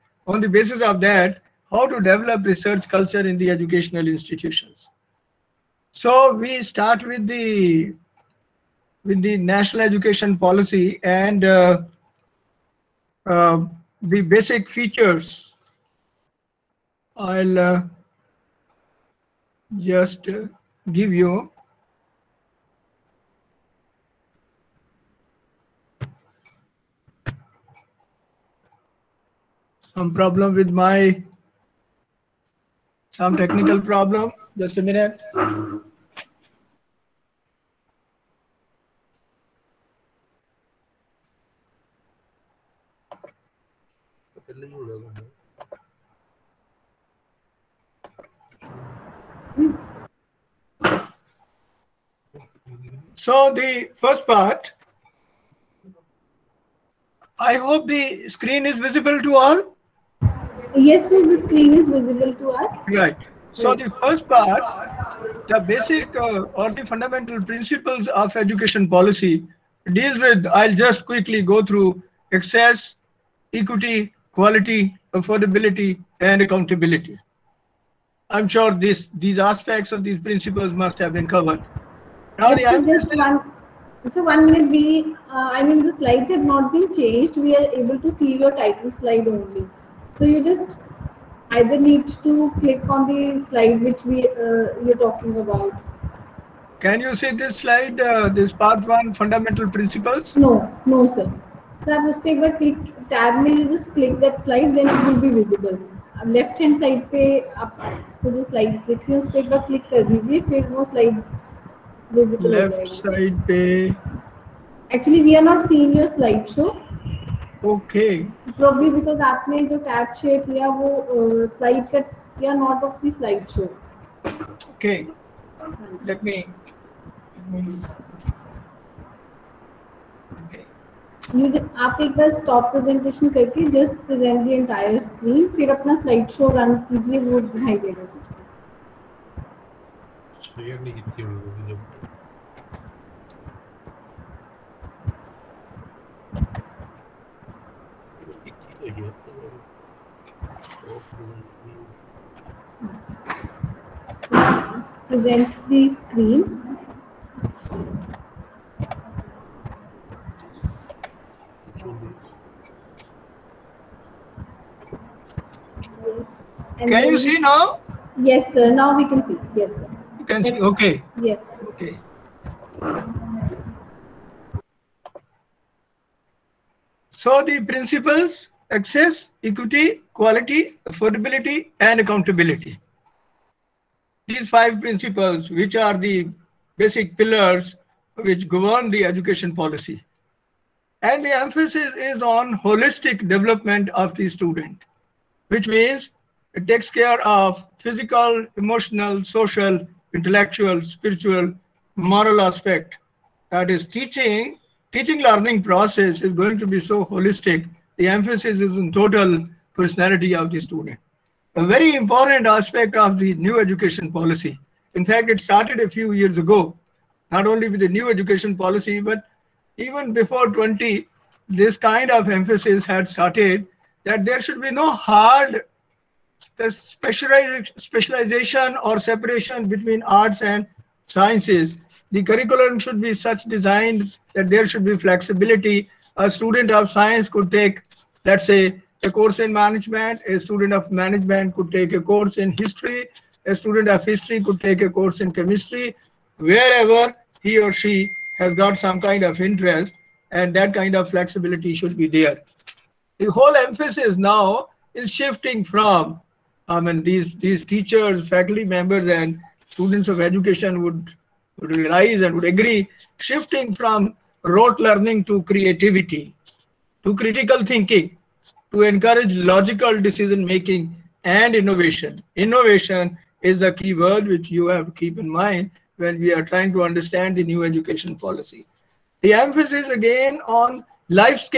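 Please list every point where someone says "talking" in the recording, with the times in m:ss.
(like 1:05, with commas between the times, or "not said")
1:35.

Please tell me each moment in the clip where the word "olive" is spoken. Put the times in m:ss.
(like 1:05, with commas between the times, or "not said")
not said.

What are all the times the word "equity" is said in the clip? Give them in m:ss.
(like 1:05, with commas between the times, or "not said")
1:13, 2:59.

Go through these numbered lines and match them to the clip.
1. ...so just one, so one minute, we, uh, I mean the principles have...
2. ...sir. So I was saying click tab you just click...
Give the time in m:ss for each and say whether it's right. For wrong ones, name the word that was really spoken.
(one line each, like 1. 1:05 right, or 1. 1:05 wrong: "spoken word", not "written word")
1. 1:22 wrong: "slides", not "principles"
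2. 1:41 right.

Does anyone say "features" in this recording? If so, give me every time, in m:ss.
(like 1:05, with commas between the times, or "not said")
0:14.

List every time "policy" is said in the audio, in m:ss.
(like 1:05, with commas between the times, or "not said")
0:10, 1:08, 3:09, 3:34, 3:38, 4:38.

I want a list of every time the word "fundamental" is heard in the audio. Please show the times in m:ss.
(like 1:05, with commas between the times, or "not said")
1:06, 1:39.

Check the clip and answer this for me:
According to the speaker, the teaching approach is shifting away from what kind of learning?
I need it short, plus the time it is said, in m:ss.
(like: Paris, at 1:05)
Rote learning, at 4:24.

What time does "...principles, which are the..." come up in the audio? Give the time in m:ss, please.
3:04.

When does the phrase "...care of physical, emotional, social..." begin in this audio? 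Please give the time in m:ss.
3:16.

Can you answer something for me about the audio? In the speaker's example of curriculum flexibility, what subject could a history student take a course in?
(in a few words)
Chemistry.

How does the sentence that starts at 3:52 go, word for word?
The curriculum should be such designed that there should be flexibility.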